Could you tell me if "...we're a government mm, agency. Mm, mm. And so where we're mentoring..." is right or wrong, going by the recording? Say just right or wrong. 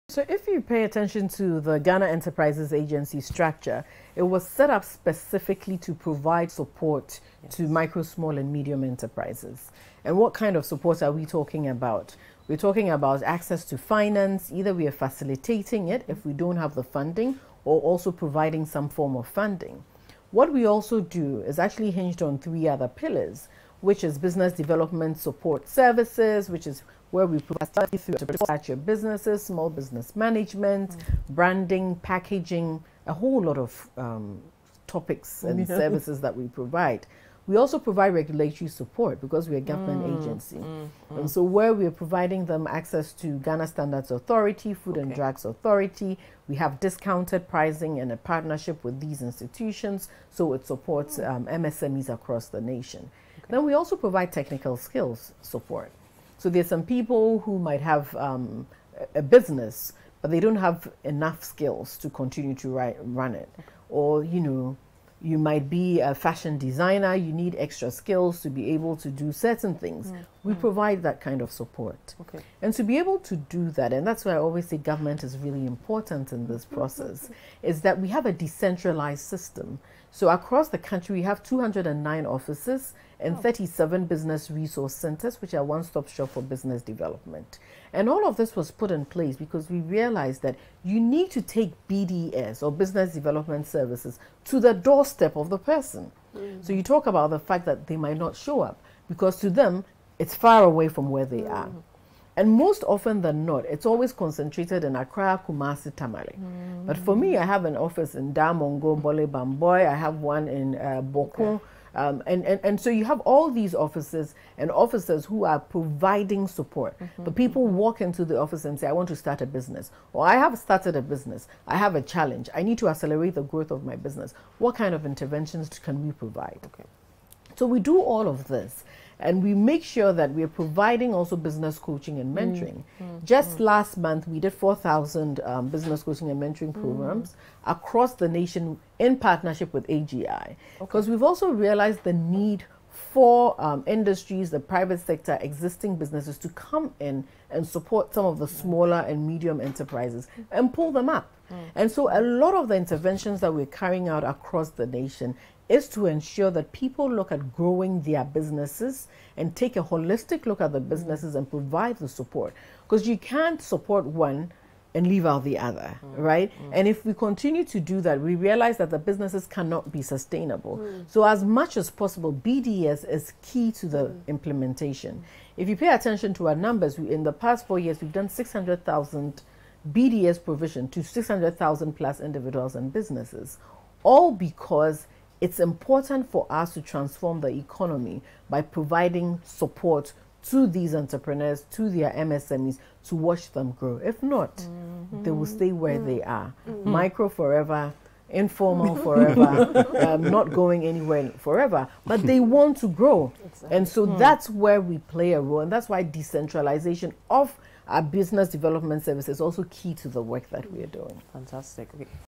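wrong.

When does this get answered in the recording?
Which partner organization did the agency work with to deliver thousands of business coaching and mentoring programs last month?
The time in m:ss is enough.
2:19.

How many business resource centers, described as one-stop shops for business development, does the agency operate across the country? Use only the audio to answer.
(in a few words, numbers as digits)
37.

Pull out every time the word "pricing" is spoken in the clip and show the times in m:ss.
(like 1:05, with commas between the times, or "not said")
0:47.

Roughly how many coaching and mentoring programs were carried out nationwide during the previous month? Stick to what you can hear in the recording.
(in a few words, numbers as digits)
4,000.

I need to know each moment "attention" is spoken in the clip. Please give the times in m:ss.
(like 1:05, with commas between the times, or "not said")
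0:00, 2:55.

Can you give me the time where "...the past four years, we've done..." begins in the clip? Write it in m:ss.
2:57.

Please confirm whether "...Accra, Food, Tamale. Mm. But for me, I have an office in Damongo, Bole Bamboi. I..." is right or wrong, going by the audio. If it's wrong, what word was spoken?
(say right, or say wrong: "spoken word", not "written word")
wrong: "Kumasi", not "Food".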